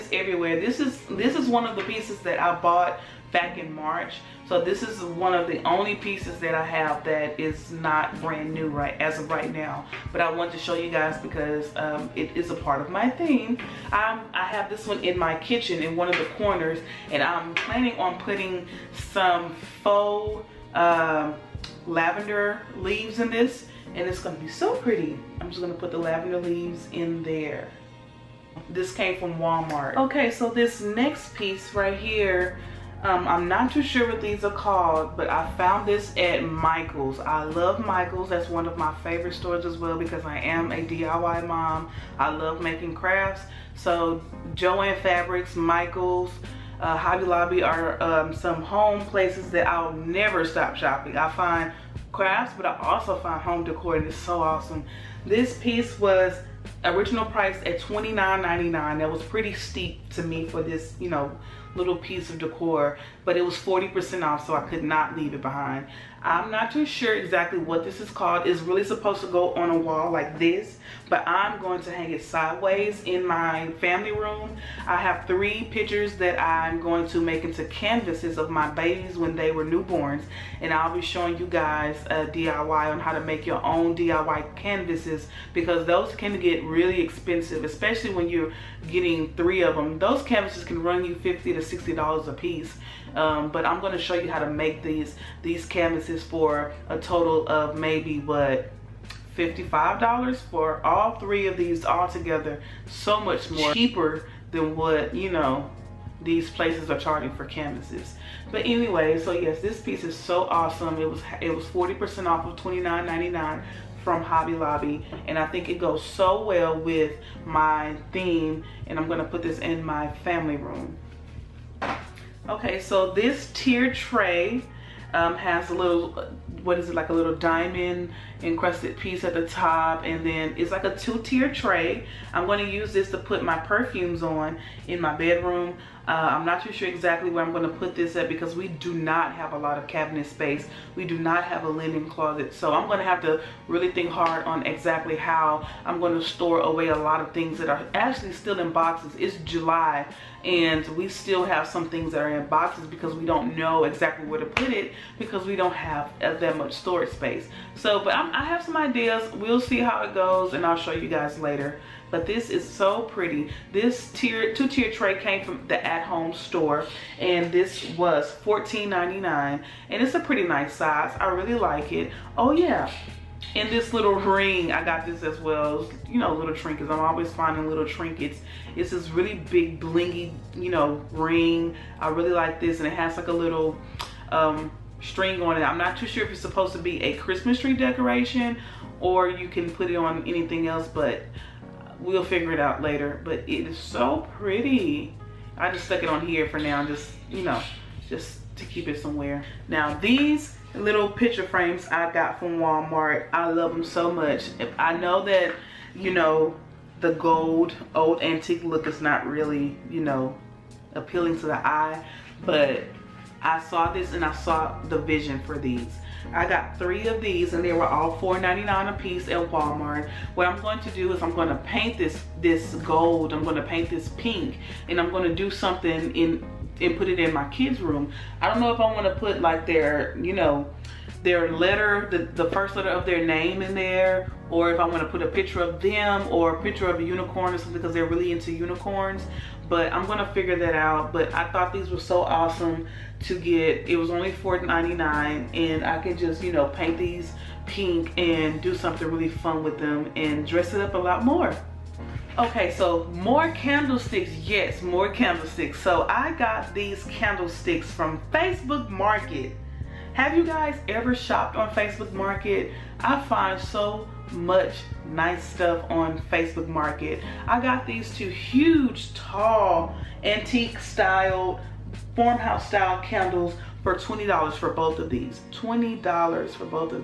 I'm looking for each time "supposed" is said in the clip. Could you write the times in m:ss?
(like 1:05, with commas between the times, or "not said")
1:08, 3:06.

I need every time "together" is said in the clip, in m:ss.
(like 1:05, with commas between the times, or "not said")
1:42.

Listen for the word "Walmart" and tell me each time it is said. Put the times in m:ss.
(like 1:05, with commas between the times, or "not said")
0:29, 3:22, 3:39.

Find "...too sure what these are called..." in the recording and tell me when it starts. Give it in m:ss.
0:33.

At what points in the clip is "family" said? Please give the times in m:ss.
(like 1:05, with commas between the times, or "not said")
1:13, 2:00.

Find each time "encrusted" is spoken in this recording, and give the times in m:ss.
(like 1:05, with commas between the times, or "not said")
2:08.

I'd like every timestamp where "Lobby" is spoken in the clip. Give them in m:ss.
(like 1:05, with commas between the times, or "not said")
0:47, 1:54.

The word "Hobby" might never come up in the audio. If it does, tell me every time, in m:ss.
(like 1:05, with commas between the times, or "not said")
0:46, 1:54.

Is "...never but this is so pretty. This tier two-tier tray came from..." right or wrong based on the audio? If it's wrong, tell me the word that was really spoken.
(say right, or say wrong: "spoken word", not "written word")
wrong: "later", not "never".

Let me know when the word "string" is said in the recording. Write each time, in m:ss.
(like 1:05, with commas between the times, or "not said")
3:05.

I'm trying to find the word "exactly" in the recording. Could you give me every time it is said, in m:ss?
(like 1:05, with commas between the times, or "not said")
1:07, 2:16, 2:24, 2:33.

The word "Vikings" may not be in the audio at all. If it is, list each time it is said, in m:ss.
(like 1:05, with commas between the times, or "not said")
not said.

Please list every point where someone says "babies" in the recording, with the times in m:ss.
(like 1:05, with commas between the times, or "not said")
1:18.